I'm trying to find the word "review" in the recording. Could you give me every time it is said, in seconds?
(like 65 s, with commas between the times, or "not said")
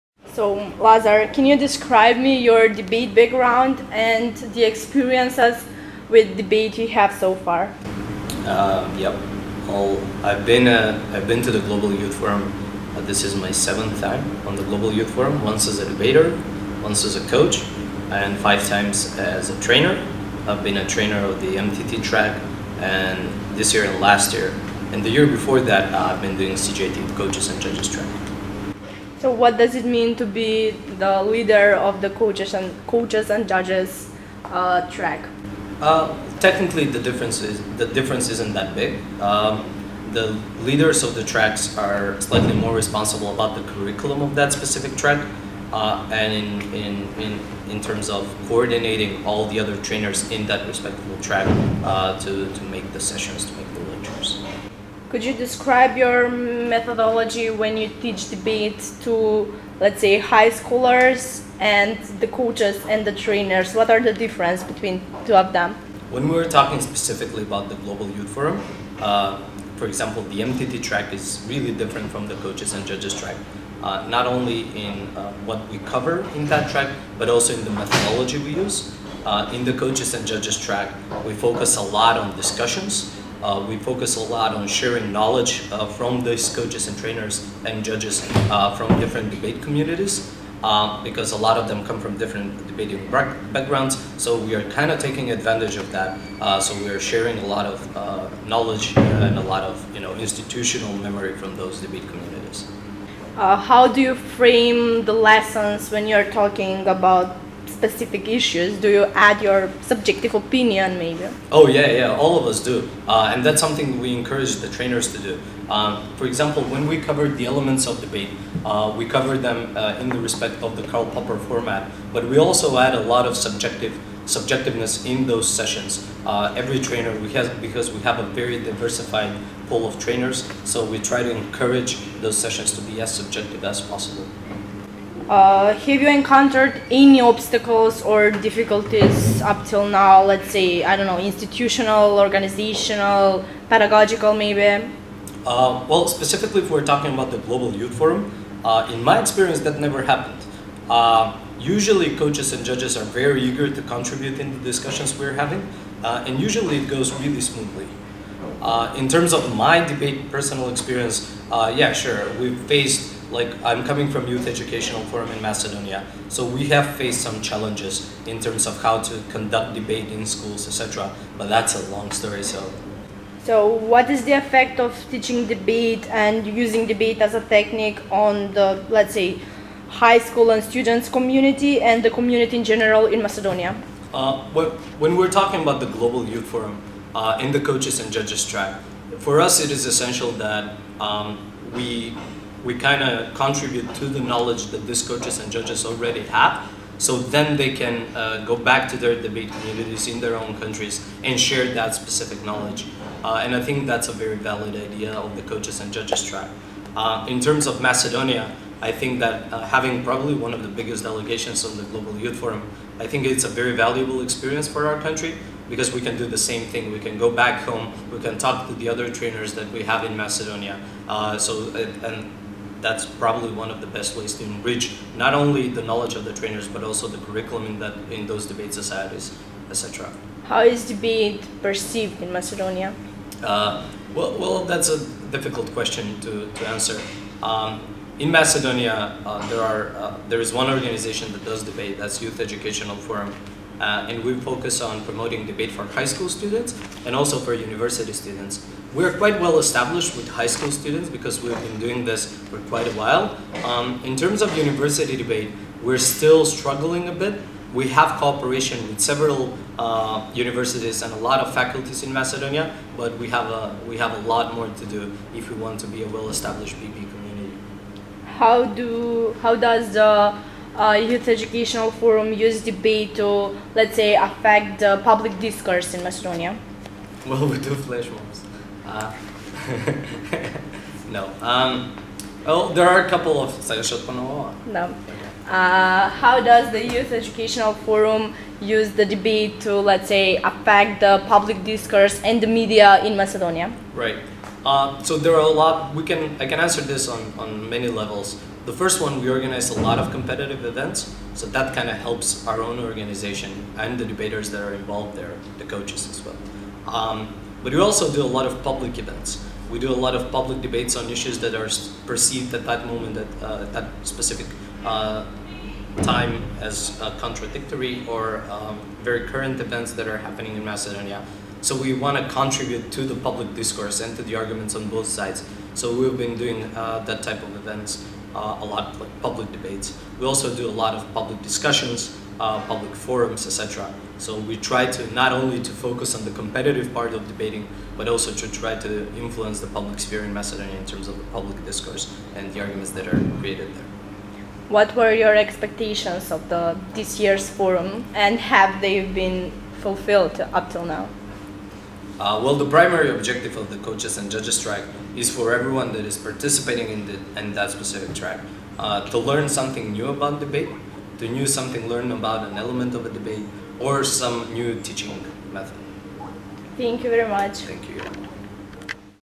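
not said.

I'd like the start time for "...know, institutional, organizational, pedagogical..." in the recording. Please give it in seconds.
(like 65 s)
141 s.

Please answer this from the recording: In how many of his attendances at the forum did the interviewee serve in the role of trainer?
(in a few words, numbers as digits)
5.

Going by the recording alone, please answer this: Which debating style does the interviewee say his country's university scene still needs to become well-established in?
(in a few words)
BP.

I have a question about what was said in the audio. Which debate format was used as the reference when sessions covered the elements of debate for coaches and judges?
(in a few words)
Karl Popper.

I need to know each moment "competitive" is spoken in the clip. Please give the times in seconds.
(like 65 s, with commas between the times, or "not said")
300 s, 336 s.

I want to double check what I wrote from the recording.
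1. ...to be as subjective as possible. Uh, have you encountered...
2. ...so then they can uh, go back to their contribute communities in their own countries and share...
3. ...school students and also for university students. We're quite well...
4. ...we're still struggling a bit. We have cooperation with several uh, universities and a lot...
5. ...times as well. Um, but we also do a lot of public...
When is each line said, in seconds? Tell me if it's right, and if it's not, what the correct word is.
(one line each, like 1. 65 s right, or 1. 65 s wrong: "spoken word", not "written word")
1. 132 s right
2. 196 s wrong: "debate", not "contribute"
3. 246 s right
4. 255 s right
5. 305 s wrong: "coaches", not "times".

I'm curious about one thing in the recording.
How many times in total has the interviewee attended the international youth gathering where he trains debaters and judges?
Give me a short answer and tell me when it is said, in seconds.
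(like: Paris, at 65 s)
7, at 13 s.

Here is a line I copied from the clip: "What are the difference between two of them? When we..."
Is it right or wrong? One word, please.
right.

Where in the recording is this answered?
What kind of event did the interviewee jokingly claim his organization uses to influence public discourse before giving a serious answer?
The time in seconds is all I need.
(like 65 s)
277 s.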